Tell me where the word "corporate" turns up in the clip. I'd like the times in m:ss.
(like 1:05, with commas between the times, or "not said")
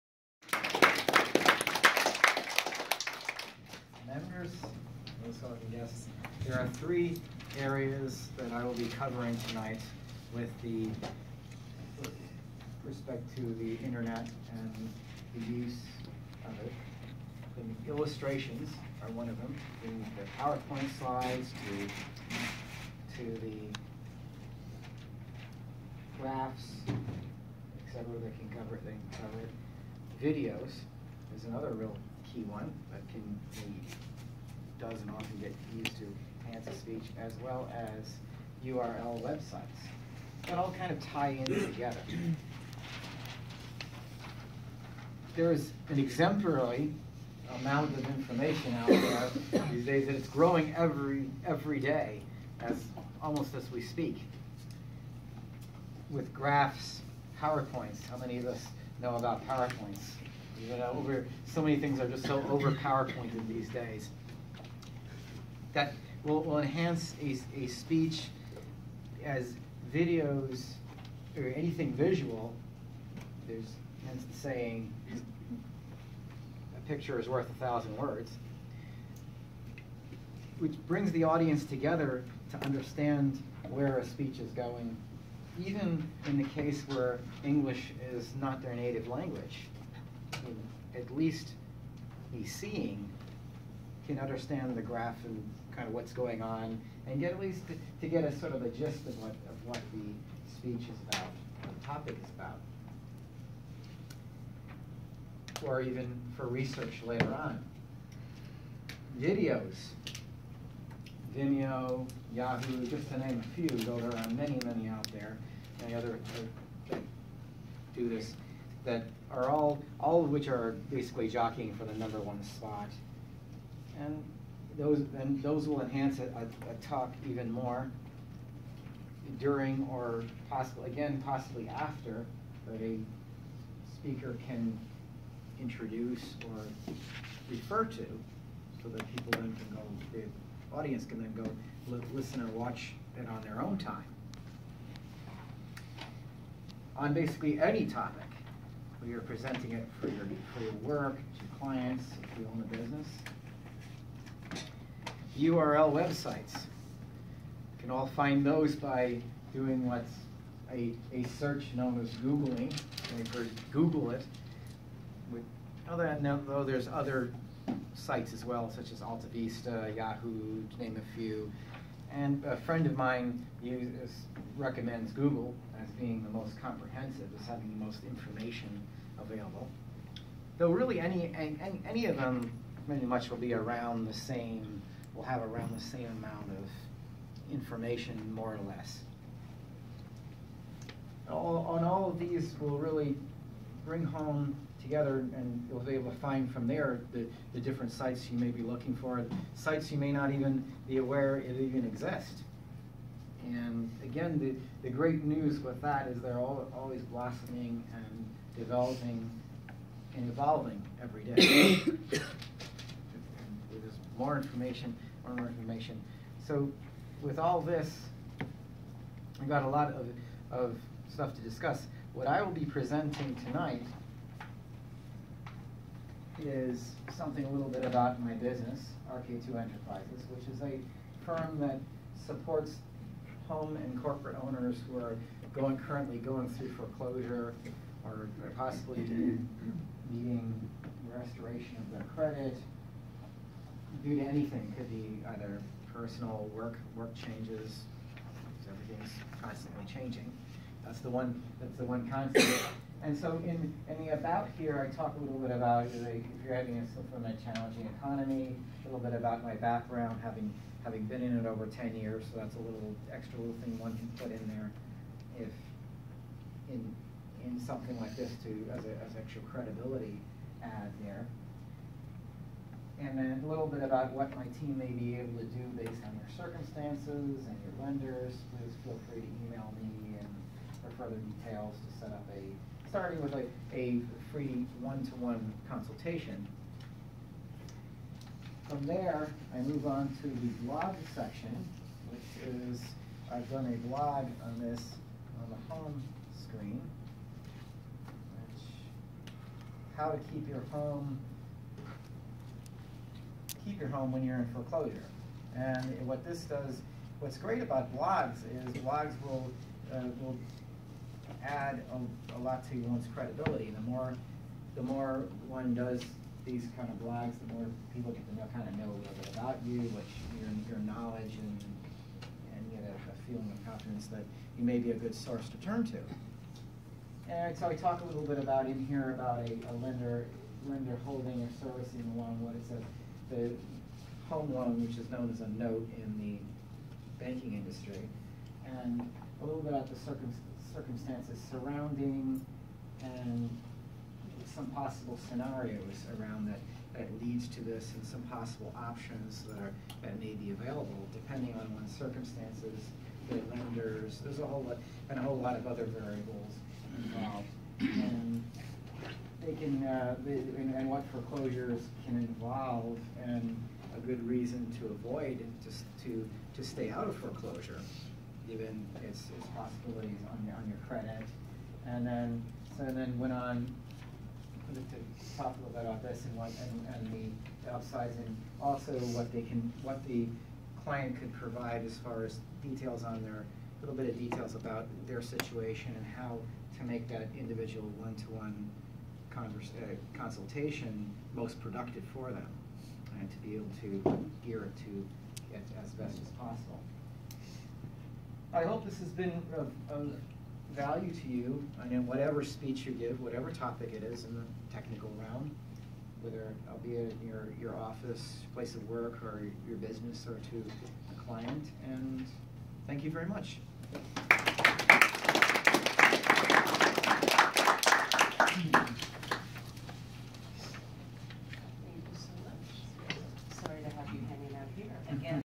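3:54.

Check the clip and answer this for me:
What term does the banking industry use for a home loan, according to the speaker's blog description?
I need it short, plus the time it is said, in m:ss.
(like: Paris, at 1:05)
note, at 5:35.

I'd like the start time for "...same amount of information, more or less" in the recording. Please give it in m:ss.
3:05.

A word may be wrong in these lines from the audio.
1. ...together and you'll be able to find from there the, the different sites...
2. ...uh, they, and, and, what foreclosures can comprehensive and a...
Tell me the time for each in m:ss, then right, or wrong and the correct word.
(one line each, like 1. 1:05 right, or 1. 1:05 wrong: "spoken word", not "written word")
1. 3:14 right
2. 5:59 wrong: "involve", not "comprehensive".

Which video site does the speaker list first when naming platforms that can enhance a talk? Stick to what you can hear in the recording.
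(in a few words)
Vimeo.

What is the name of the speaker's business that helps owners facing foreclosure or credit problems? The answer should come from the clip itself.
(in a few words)
RK2 Enterprises.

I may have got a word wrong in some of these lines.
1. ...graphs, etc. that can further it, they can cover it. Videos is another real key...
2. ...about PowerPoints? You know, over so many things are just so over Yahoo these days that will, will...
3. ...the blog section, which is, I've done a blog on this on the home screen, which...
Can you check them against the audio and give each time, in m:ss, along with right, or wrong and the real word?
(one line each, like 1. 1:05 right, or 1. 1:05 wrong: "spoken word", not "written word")
1. 0:26 wrong: "cover", not "further"
2. 0:59 wrong: "PowerPointed", not "Yahoo"
3. 4:50 right.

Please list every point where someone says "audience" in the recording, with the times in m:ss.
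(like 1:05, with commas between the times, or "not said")
1:21, 2:20.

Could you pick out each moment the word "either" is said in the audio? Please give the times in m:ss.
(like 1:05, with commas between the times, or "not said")
4:05.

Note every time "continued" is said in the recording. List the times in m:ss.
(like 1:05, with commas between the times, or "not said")
not said.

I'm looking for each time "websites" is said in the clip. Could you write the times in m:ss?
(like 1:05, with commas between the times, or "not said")
0:39, 2:35.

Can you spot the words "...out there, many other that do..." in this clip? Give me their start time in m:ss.
1:54.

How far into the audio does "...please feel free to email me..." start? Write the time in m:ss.
4:38.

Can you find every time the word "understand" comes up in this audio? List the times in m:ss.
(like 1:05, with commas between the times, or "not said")
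1:22, 1:34.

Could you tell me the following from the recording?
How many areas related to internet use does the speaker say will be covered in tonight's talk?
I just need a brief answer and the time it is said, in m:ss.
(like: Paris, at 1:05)
3, at 0:06.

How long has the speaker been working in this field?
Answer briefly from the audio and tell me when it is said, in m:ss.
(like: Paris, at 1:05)
over 10 years, at 4:21.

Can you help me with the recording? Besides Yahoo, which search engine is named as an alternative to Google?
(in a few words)
AltaVista.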